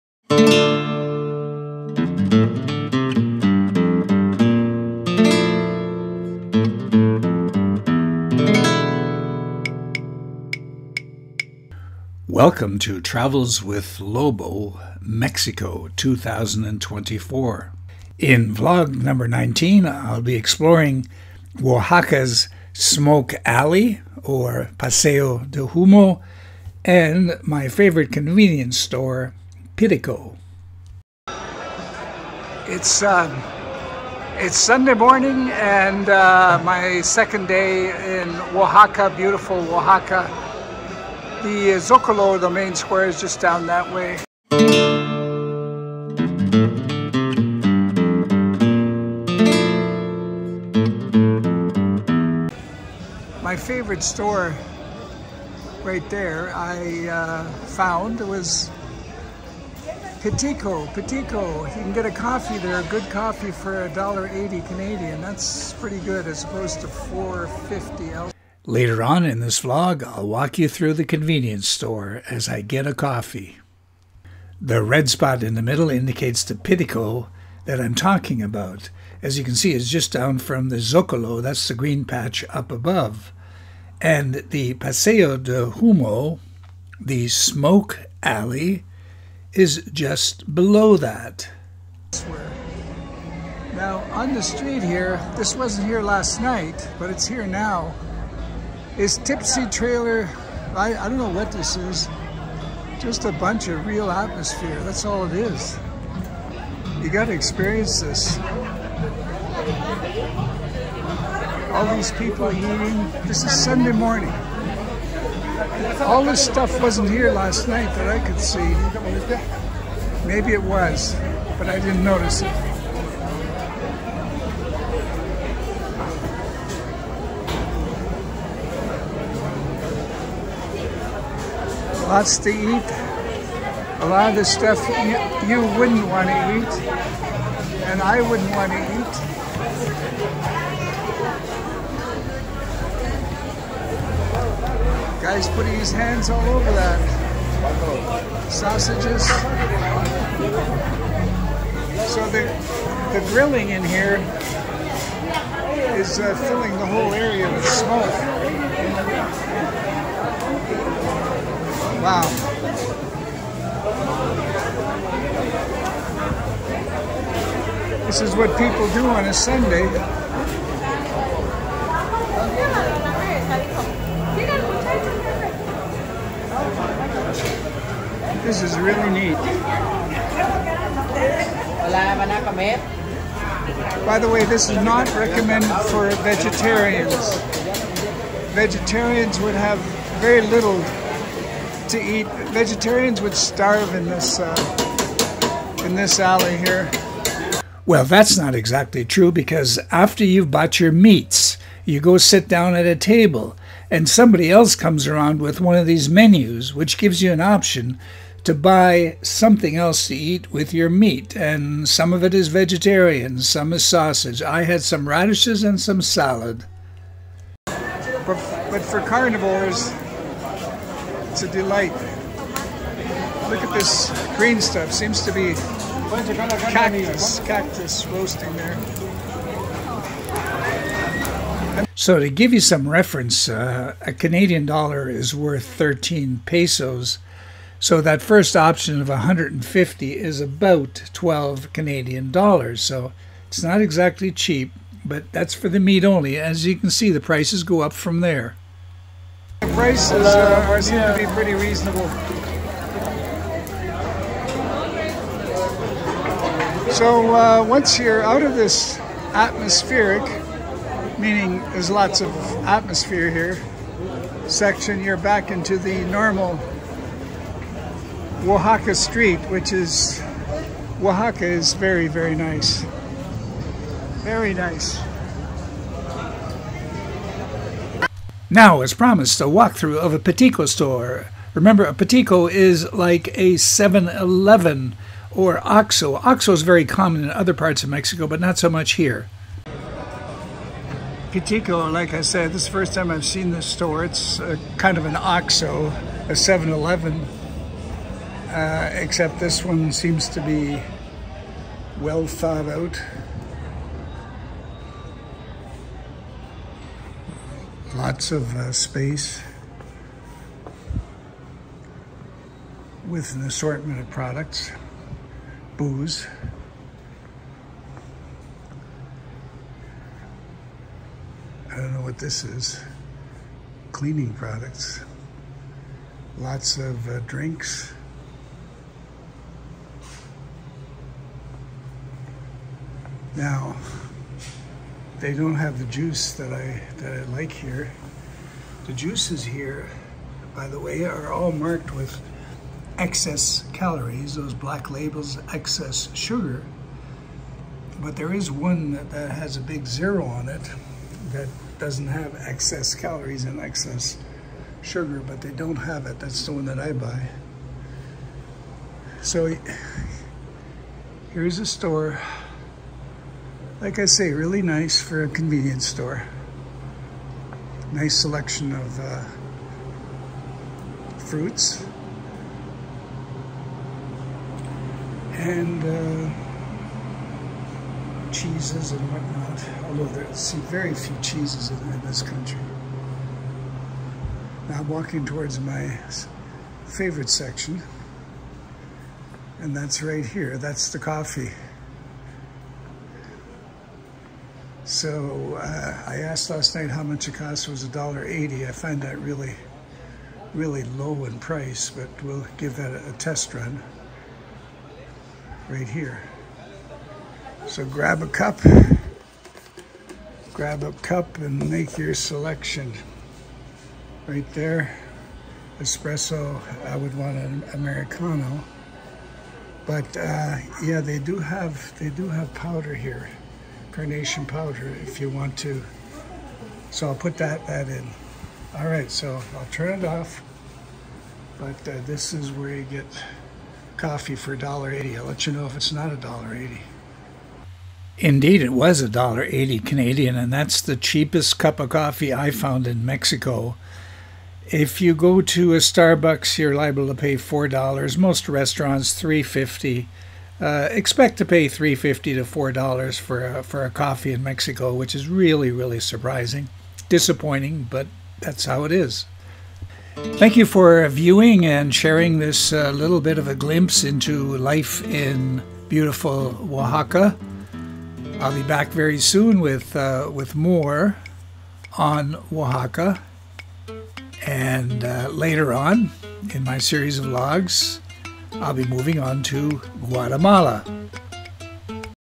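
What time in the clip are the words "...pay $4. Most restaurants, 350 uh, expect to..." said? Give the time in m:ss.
7:27.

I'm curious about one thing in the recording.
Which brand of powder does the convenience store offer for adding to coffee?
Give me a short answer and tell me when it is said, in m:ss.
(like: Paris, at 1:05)
Carnation, at 7:03.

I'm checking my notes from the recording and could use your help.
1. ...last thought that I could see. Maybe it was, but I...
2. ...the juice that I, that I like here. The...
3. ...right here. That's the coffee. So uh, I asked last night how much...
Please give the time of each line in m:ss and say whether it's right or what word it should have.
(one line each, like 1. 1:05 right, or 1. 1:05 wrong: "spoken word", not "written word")
1. 1:57 wrong: "night", not "thought"
2. 5:35 right
3. 6:30 right.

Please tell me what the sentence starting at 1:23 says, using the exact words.
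And the Paseo de Humo, the smoke alley, is just below that.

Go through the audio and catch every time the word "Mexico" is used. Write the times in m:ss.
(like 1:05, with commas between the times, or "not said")
0:14, 4:47, 7:23, 7:34.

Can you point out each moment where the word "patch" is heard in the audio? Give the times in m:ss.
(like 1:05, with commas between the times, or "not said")
1:22.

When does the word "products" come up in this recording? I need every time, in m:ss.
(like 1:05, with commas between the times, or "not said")
5:14, 5:24.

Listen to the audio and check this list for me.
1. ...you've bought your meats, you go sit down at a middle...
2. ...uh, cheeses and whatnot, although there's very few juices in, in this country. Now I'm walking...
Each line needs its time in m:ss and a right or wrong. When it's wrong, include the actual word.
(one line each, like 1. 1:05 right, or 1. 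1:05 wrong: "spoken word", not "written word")
1. 3:20 wrong: "table", not "middle"
2. 6:15 wrong: "cheeses", not "juices".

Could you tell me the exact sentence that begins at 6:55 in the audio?
Espresso, I would want an Americano.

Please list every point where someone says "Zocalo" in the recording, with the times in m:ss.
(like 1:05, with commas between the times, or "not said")
0:41, 1:20.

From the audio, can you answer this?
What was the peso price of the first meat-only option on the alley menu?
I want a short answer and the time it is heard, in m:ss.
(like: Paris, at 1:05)
150, at 3:59.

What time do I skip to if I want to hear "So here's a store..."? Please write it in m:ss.
5:59.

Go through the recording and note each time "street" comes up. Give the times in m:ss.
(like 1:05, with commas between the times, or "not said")
1:34, 4:28.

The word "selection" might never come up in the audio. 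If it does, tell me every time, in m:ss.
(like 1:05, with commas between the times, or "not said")
6:08, 6:52.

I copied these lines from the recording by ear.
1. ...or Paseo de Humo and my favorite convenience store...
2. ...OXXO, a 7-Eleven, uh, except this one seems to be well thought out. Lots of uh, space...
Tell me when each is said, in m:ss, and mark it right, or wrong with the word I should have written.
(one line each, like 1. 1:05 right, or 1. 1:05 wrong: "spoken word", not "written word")
1. 0:24 right
2. 4:55 right.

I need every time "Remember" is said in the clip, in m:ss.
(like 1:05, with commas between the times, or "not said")
4:41.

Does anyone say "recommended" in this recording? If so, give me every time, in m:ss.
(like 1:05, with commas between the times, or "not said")
3:05.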